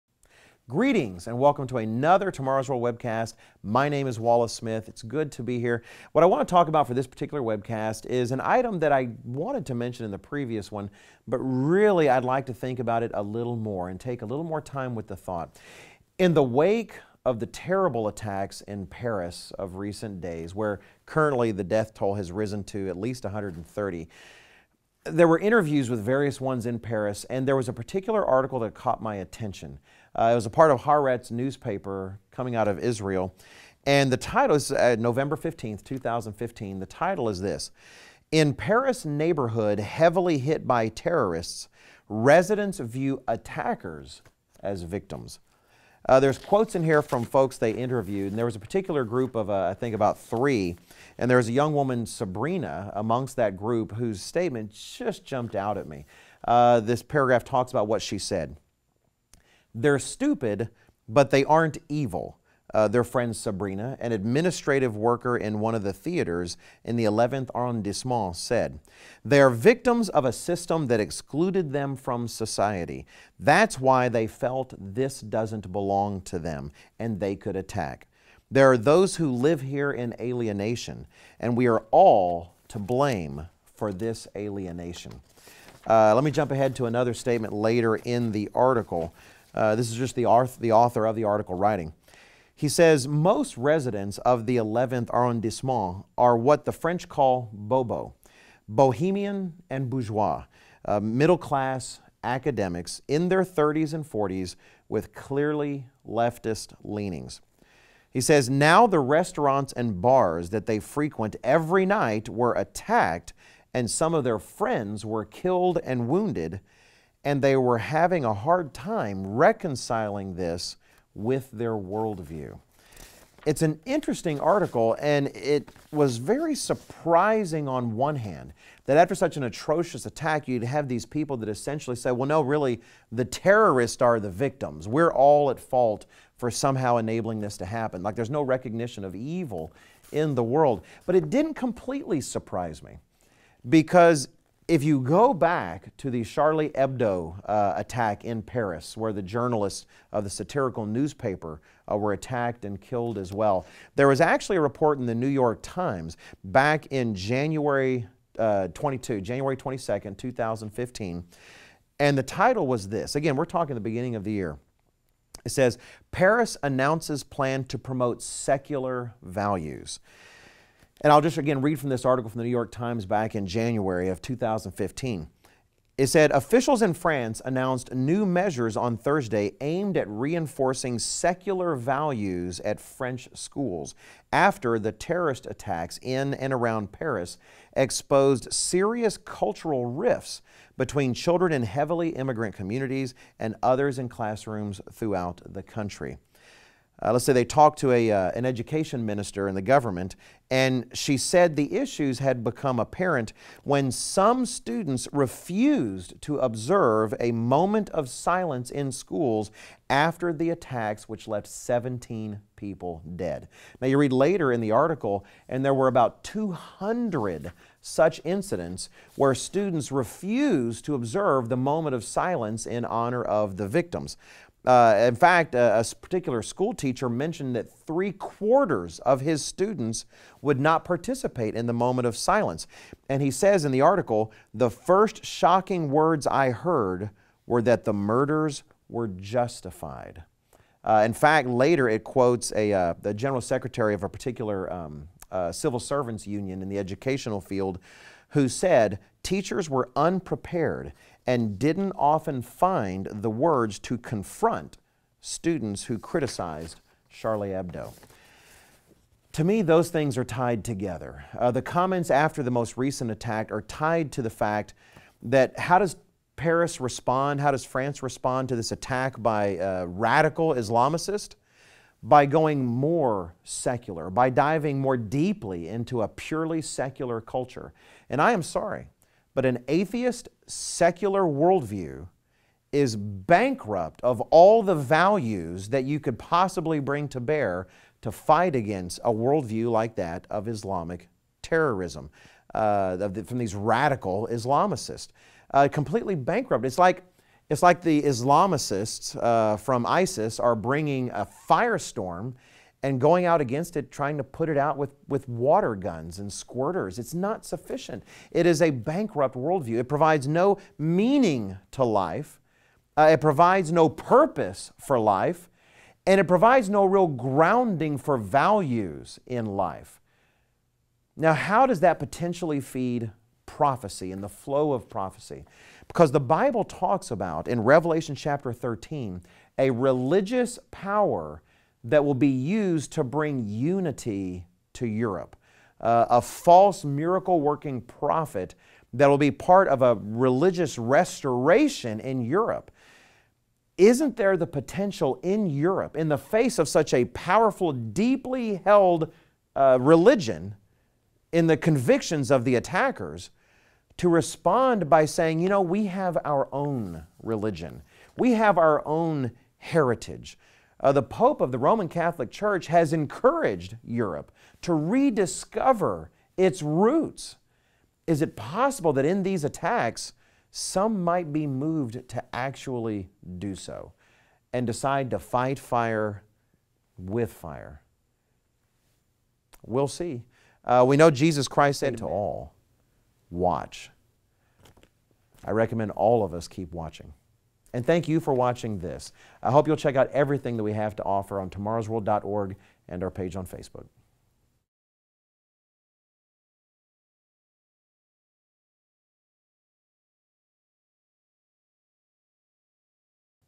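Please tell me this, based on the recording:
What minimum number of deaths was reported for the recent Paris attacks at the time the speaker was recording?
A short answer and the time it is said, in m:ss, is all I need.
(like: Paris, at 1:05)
130, at 0:23.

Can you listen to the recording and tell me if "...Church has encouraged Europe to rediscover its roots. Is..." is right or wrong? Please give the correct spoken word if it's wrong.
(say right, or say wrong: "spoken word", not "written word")
right.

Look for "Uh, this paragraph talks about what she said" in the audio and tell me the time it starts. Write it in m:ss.
0:56.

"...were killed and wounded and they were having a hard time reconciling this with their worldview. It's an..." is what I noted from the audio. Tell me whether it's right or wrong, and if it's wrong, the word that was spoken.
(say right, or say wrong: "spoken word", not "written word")
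right.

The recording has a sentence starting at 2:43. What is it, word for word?
Again, we're talking the beginning of the year.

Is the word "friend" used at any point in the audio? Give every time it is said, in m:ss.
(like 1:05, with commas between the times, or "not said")
1:03, 1:54.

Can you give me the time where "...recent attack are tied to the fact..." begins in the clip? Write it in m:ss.
4:22.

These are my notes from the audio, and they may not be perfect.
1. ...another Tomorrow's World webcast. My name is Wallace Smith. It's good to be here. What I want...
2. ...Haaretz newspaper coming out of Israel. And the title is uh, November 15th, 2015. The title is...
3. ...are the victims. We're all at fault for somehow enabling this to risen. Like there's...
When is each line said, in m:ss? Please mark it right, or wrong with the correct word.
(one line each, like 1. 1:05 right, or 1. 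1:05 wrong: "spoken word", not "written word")
1. 0:01 right
2. 0:30 right
3. 2:14 wrong: "happen", not "risen".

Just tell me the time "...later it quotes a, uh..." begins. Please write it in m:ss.
4:01.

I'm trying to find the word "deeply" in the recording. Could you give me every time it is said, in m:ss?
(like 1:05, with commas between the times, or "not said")
4:34, 5:47.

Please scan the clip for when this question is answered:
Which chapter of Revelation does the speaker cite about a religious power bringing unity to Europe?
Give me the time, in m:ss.
5:28.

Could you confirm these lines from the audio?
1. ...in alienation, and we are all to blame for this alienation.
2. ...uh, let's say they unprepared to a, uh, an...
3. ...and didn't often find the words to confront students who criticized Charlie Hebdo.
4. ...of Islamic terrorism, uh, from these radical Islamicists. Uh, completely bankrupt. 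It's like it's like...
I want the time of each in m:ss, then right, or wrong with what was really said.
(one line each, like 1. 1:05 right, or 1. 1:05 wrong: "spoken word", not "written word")
1. 1:19 right
2. 3:17 wrong: "talked", not "unprepared"
3. 4:11 right
4. 4:50 right.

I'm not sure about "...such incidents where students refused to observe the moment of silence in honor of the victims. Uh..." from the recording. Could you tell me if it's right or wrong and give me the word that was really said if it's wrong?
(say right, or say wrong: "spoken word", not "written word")
right.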